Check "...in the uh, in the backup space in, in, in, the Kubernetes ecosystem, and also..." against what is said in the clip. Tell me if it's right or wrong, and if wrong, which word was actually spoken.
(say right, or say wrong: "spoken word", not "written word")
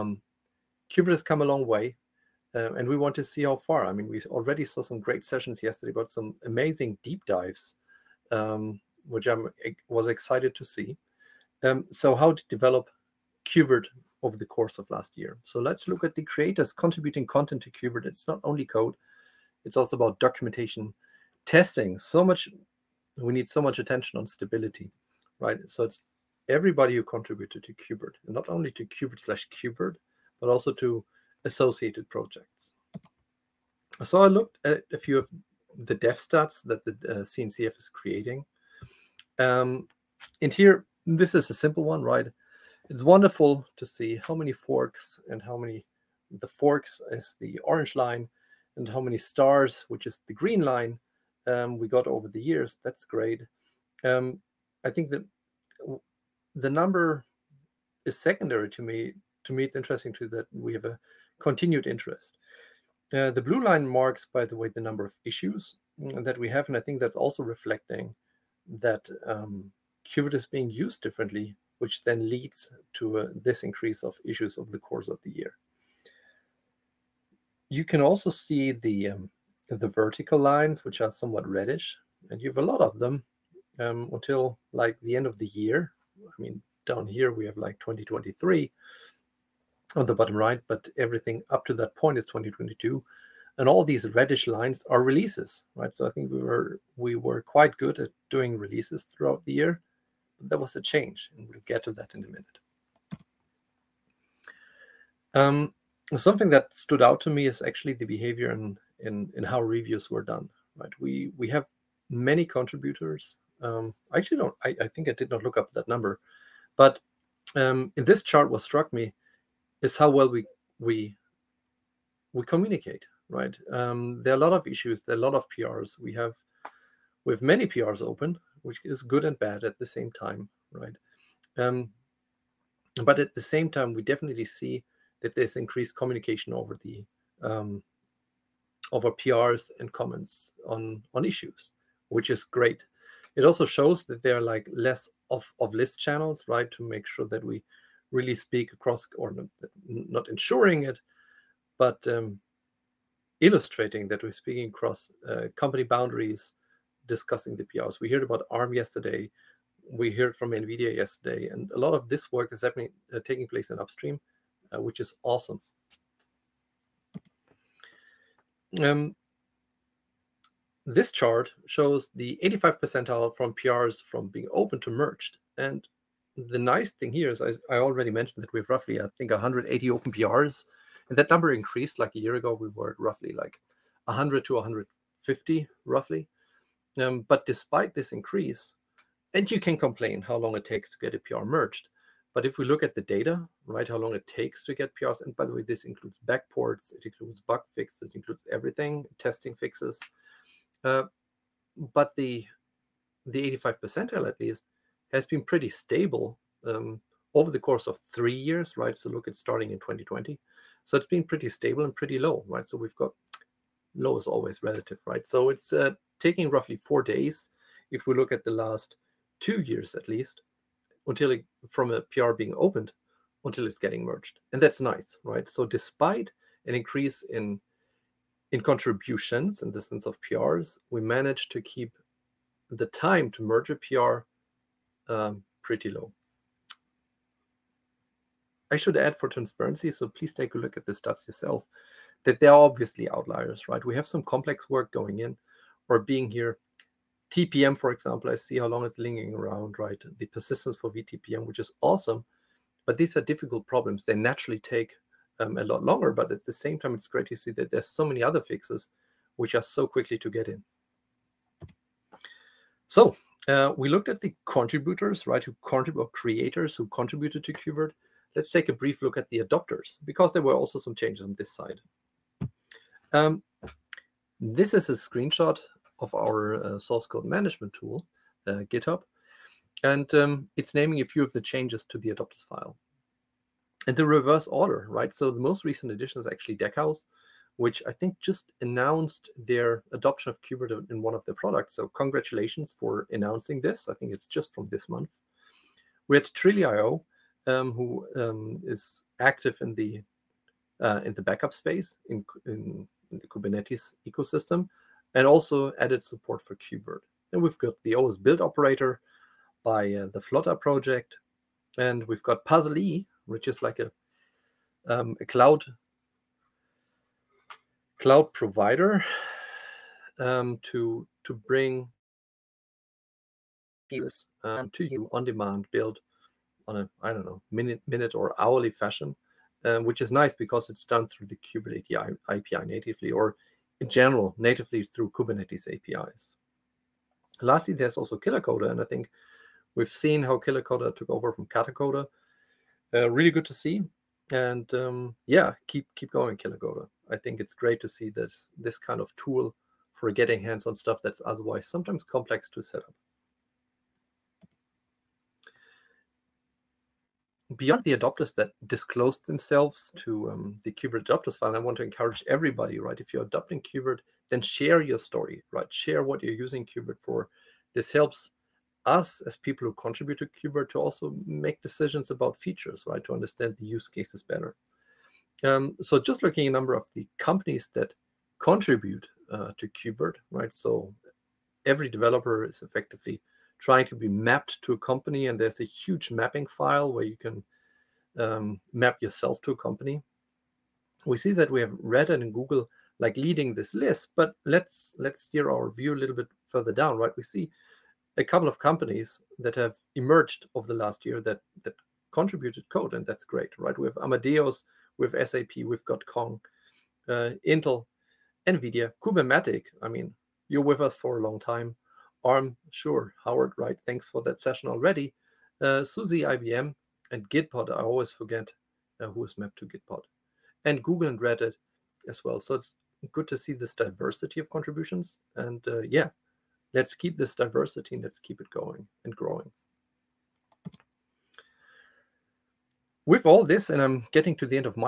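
right.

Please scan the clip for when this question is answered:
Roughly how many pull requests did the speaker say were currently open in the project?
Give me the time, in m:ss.
2:59.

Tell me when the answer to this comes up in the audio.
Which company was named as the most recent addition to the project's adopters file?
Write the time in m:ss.
4:46.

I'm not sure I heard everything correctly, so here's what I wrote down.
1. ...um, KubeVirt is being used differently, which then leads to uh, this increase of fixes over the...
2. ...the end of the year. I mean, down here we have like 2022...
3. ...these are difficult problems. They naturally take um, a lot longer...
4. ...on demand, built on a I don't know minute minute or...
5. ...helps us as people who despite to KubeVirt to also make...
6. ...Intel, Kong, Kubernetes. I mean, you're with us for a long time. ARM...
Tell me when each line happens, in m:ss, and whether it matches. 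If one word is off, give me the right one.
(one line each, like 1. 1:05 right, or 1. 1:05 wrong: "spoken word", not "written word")
1. 1:09 wrong: "issues", not "fixes"
2. 1:25 wrong: "2023", not "2022"
3. 4:12 right
4. 5:25 right
5. 6:07 wrong: "contribute", not "despite"
6. 6:47 wrong: "NVIDIA", not "Kong".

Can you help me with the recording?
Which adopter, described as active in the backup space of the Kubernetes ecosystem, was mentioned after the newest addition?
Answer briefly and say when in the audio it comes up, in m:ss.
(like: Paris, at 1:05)
Trilio, at 4:56.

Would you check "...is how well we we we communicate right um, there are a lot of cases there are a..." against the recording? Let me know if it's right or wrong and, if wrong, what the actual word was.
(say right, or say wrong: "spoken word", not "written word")
wrong: "issues", not "cases".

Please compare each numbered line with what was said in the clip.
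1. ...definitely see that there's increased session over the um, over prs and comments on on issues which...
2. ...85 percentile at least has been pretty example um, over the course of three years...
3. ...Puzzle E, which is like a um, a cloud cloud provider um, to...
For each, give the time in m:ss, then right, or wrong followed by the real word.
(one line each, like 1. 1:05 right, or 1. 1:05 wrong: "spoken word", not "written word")
1. 2:14 wrong: "communication", not "session"
2. 3:23 wrong: "stable", not "example"
3. 5:12 right.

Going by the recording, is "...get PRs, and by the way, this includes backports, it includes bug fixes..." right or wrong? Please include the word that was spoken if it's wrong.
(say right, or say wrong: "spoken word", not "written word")
right.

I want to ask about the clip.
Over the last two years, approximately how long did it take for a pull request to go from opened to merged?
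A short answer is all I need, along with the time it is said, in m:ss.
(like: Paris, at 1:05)
four days, at 3:36.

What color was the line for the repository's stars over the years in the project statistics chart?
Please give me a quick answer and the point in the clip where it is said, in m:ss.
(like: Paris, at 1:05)
green, at 0:50.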